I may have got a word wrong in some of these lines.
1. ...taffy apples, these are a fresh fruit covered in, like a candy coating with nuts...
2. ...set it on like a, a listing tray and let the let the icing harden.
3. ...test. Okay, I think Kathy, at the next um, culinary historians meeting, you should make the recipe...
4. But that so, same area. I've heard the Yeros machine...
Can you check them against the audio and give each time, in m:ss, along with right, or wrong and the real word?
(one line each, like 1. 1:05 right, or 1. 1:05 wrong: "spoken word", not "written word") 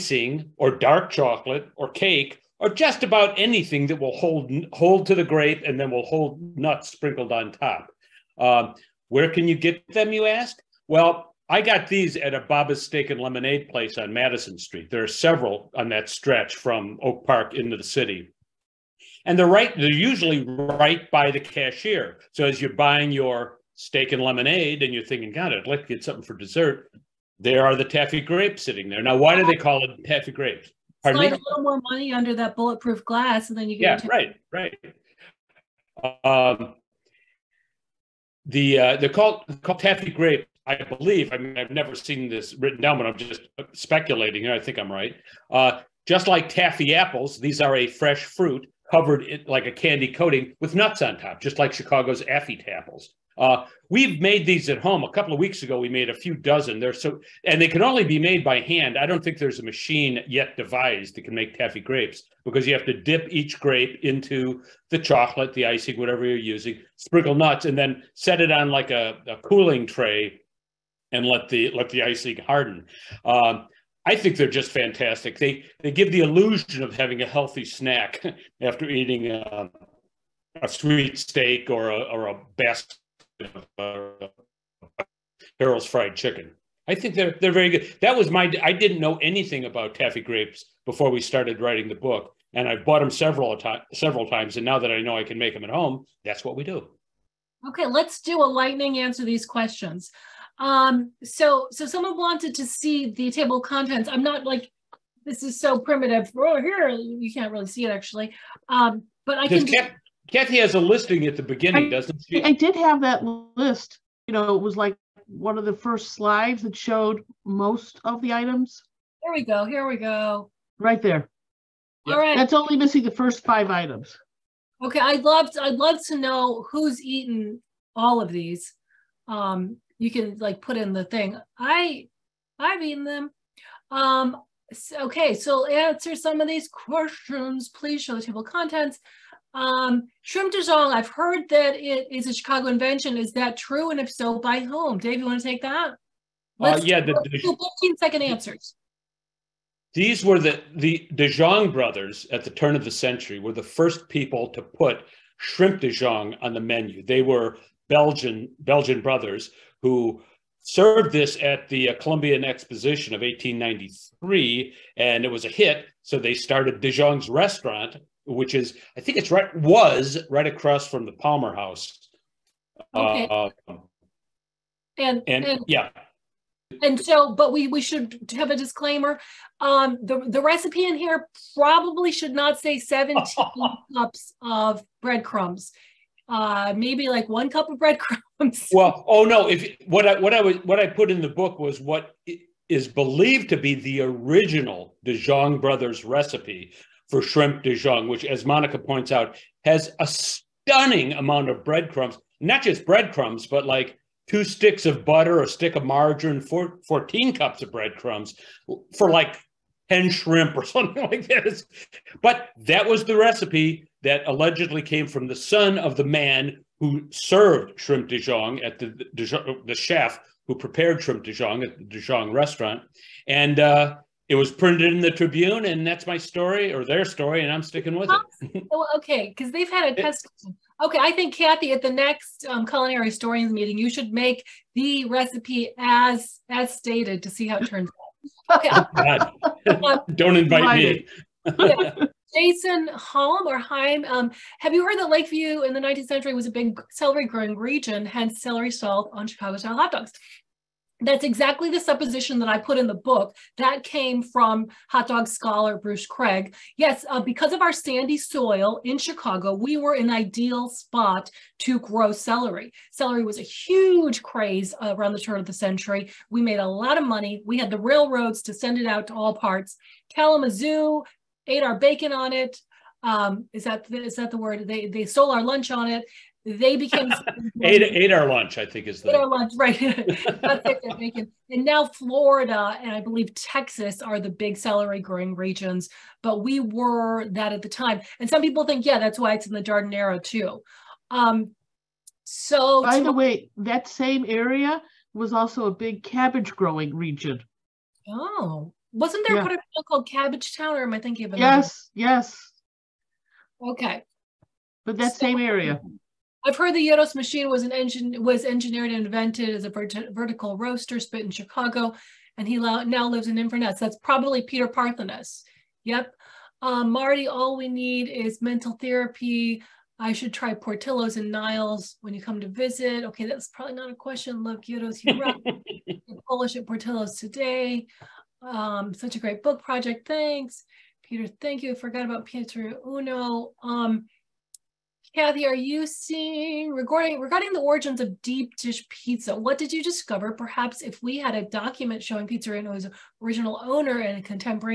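1. 0:46 right
2. 1:08 wrong: "cooling", not "listing"
3. 3:50 right
4. 5:04 right.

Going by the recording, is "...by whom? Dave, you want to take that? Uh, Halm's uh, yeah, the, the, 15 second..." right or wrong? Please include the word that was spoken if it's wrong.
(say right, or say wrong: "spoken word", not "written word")
wrong: "Let", not "Halm".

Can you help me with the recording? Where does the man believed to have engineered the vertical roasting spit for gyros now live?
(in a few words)
Inverness.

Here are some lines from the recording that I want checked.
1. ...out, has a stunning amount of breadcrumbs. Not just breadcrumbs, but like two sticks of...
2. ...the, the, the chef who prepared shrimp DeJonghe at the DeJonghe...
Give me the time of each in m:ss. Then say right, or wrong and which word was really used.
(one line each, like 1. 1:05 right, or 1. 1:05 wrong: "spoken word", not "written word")
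1. 3:19 right
2. 3:38 right.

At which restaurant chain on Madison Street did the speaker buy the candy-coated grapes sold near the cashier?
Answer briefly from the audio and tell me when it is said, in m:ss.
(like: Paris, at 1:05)
Baba's Steak and Lemonade, at 0:12.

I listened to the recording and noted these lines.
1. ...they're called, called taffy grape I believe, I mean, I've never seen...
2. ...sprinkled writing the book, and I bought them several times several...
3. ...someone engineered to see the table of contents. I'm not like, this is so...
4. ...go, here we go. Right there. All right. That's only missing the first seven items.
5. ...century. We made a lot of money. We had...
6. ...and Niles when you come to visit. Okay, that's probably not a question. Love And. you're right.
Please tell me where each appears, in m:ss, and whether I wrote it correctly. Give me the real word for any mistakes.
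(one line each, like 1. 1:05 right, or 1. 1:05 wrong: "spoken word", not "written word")
1. 0:38 right
2. 1:31 wrong: "started", not "sprinkled"
3. 1:41 wrong: "wanted", not "engineered"
4. 1:59 wrong: "five", not "seven"
5. 4:25 right
6. 5:21 wrong: "Yeros", not "And".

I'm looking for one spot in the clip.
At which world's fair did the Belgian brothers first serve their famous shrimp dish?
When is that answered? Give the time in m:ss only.
2:41.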